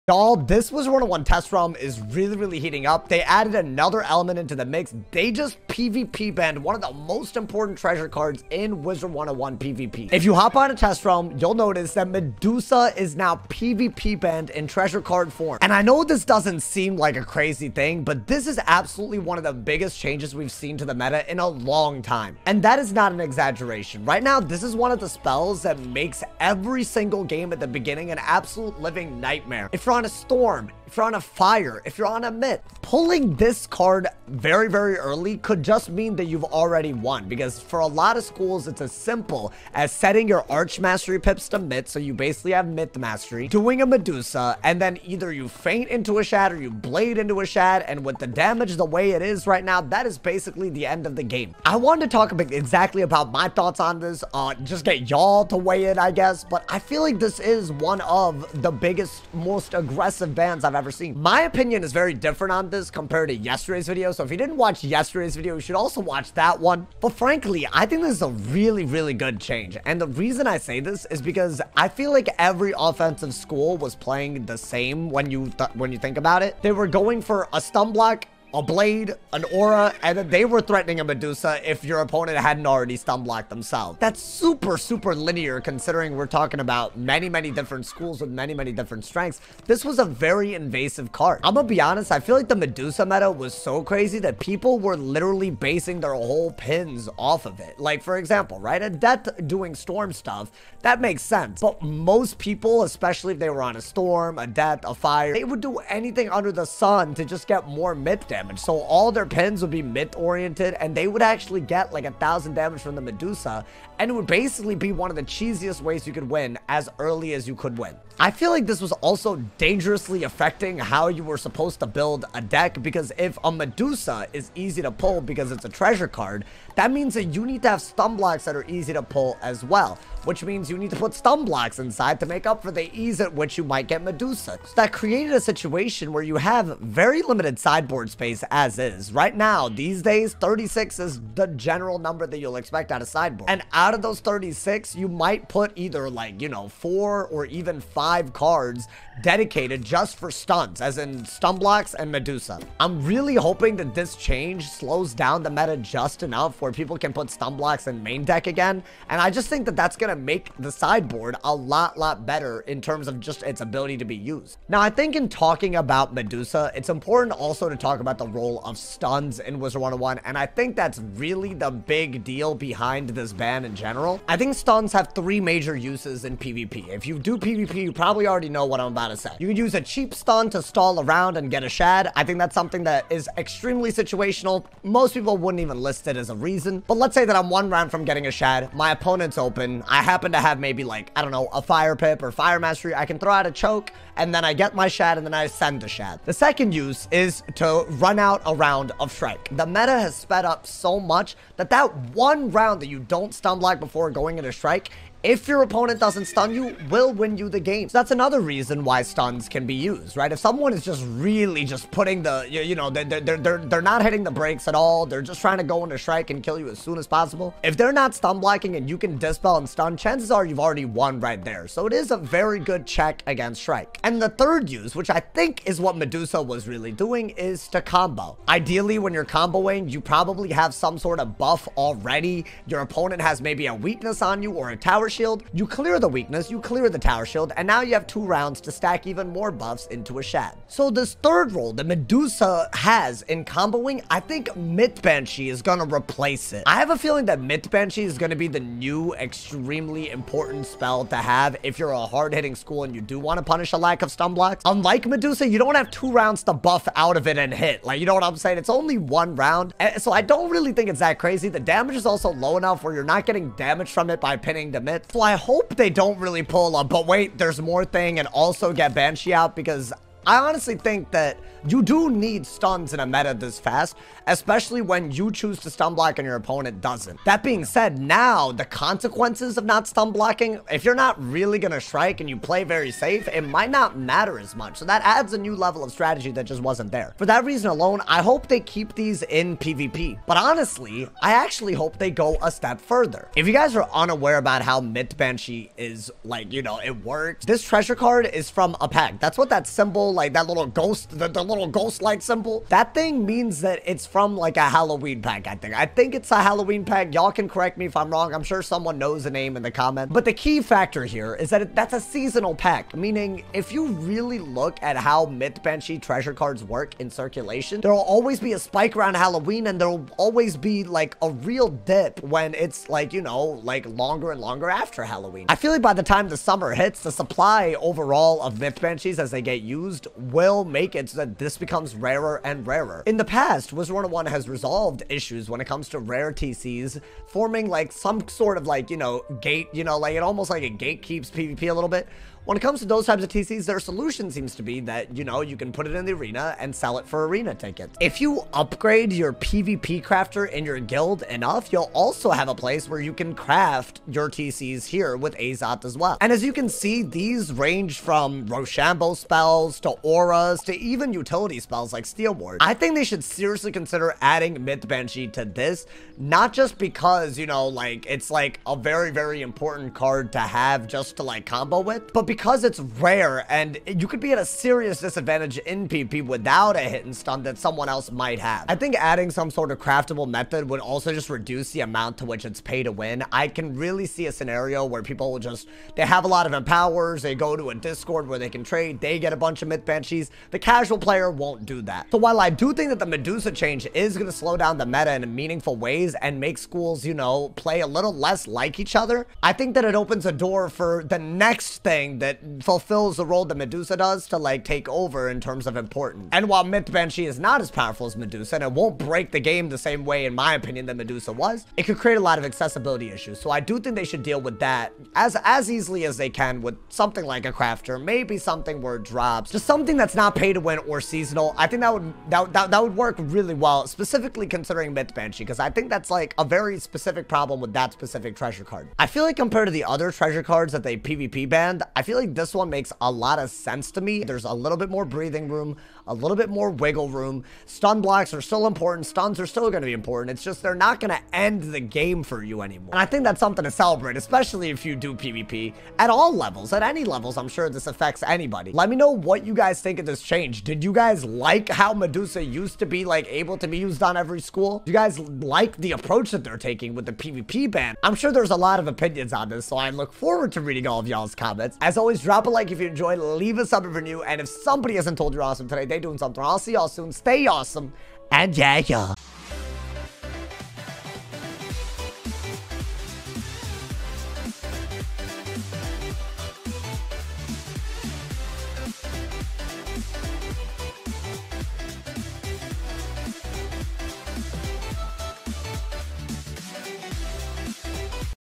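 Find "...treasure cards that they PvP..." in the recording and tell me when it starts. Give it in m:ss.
7:10.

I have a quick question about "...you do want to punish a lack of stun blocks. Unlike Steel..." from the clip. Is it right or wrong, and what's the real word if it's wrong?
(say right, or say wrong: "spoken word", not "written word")
wrong: "Medusa", not "Steel".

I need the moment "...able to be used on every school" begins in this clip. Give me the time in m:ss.
7:33.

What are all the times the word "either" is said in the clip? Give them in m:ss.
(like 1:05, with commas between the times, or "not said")
0:45, 2:25.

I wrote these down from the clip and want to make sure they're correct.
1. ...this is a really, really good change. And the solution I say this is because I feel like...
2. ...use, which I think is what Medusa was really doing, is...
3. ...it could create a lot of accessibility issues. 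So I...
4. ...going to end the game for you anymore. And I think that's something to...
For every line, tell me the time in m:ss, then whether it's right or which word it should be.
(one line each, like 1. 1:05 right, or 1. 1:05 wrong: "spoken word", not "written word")
1. 1:08 wrong: "reason", not "solution"
2. 3:44 right
3. 6:51 right
4. 7:20 right.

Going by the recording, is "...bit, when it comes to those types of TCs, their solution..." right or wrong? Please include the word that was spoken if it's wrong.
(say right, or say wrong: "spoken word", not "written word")
right.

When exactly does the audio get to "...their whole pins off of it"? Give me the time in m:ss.
1:36.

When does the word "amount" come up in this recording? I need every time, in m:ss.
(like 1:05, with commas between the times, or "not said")
6:21.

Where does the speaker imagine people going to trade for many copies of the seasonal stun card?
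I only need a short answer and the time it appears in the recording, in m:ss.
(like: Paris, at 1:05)
Discord, at 6:27.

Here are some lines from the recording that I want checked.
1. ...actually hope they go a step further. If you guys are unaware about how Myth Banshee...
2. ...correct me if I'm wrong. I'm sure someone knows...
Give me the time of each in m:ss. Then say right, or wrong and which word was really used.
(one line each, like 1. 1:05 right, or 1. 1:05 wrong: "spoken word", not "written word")
1. 4:51 right
2. 5:07 right.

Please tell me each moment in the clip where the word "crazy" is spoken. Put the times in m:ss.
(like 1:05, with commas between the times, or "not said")
0:17, 1:33, 4:21.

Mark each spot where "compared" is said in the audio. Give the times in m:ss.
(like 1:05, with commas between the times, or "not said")
1:02, 7:09.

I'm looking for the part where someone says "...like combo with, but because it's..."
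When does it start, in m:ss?
6:11.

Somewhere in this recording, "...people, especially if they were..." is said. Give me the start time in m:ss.
1:42.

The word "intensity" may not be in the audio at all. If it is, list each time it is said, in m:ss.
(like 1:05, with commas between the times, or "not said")
not said.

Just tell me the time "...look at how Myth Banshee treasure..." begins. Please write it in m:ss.
5:14.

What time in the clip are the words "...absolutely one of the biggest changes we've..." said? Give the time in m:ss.
0:18.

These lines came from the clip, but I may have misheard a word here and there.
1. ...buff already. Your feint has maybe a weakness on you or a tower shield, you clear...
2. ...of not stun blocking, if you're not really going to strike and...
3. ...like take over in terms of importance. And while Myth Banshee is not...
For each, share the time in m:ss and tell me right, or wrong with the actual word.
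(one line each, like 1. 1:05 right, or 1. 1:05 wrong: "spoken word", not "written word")
1. 3:51 wrong: "opponent", not "feint"
2. 4:39 right
3. 6:44 right.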